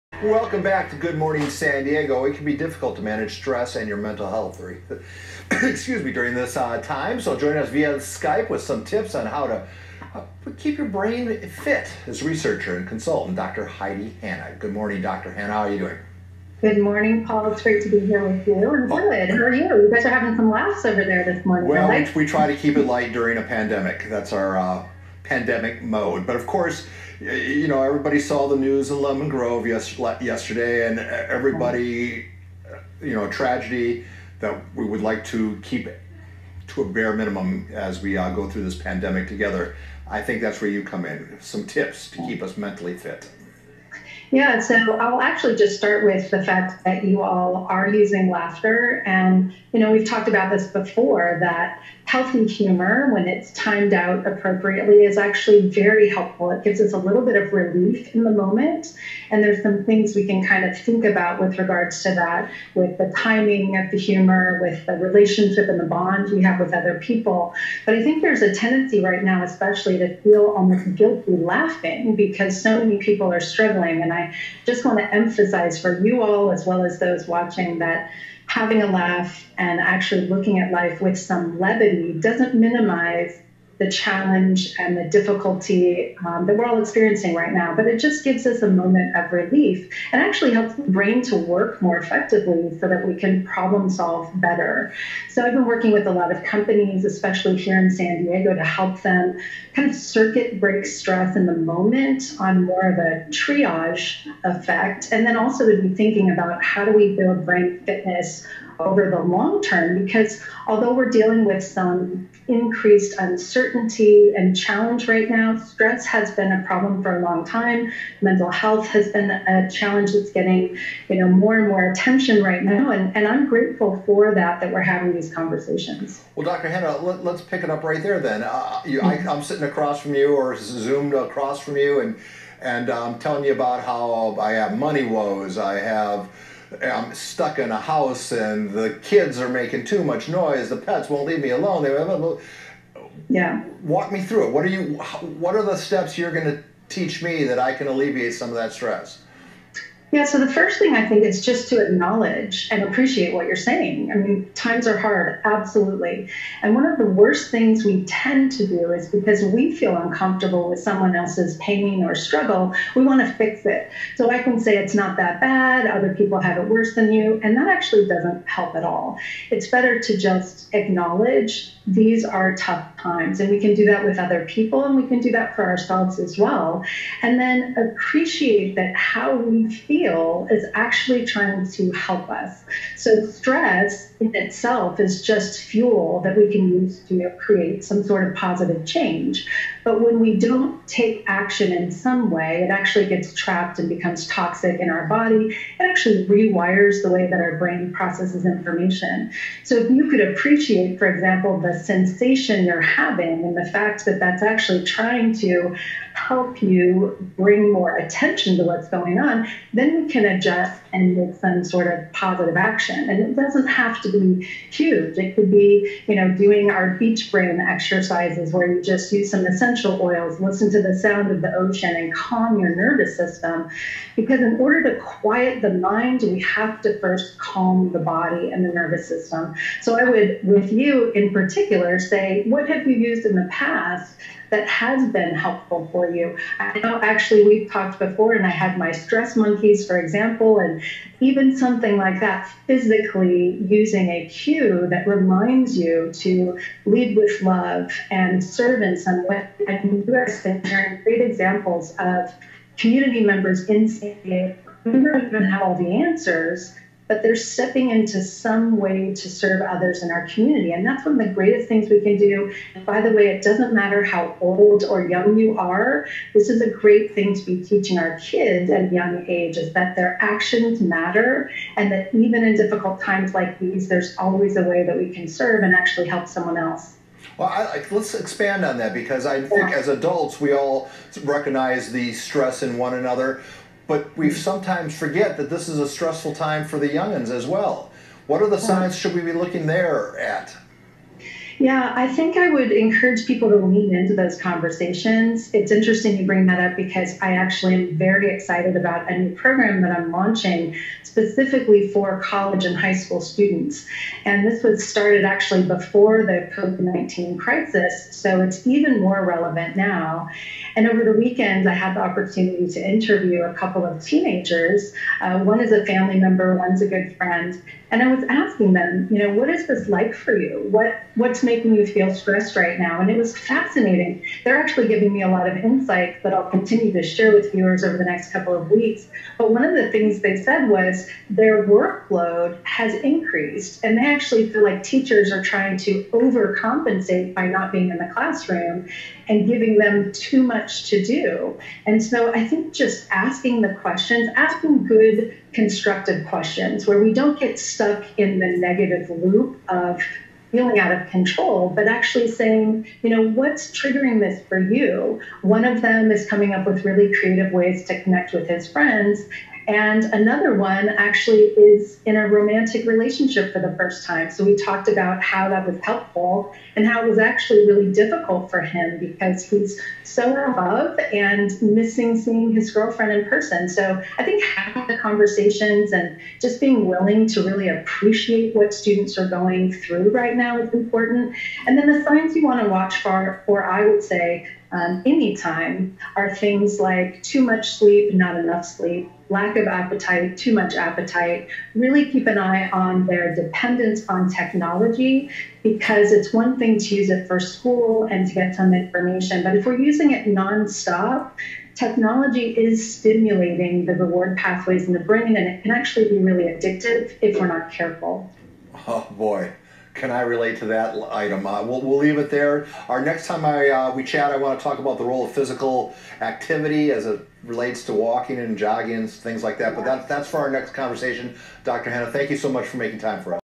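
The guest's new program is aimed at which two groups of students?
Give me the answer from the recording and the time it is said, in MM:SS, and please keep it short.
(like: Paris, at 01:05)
College and high school, at 05:02.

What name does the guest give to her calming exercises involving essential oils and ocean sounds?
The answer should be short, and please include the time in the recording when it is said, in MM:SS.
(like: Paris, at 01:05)
Beach brain exercises, at 03:36.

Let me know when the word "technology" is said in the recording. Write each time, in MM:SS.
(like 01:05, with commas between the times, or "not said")
06:34, 06:41.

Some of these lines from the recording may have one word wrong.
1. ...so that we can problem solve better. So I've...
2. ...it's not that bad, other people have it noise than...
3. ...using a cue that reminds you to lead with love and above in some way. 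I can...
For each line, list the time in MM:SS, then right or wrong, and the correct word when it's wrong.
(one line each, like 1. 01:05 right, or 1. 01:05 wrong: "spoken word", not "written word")
1. 01:32 right
2. 02:44 wrong: "worse", not "noise"
3. 04:03 wrong: "serve", not "above".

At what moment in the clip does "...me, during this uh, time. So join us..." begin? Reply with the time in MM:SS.
00:06.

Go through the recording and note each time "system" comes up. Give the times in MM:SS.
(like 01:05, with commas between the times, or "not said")
03:43, 03:49.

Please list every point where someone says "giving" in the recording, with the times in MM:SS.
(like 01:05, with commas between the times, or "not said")
05:24, 05:39.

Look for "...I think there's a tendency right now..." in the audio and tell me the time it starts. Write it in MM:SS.
01:07.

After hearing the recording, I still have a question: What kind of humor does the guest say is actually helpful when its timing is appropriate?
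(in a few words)
Healthy humor.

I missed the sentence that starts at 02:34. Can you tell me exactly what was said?
I mean, times are hard, absolutely.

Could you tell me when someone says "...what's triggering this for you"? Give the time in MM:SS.
05:53.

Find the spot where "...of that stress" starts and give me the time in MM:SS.
02:28.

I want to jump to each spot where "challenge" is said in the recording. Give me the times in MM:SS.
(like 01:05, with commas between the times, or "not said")
01:23, 01:54, 01:59.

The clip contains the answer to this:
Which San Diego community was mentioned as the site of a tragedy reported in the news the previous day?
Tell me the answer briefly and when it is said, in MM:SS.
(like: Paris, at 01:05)
Lemon Grove, at 00:29.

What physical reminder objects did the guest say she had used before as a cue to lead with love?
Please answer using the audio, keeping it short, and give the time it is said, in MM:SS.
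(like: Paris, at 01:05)
Stress monkeys, at 03:58.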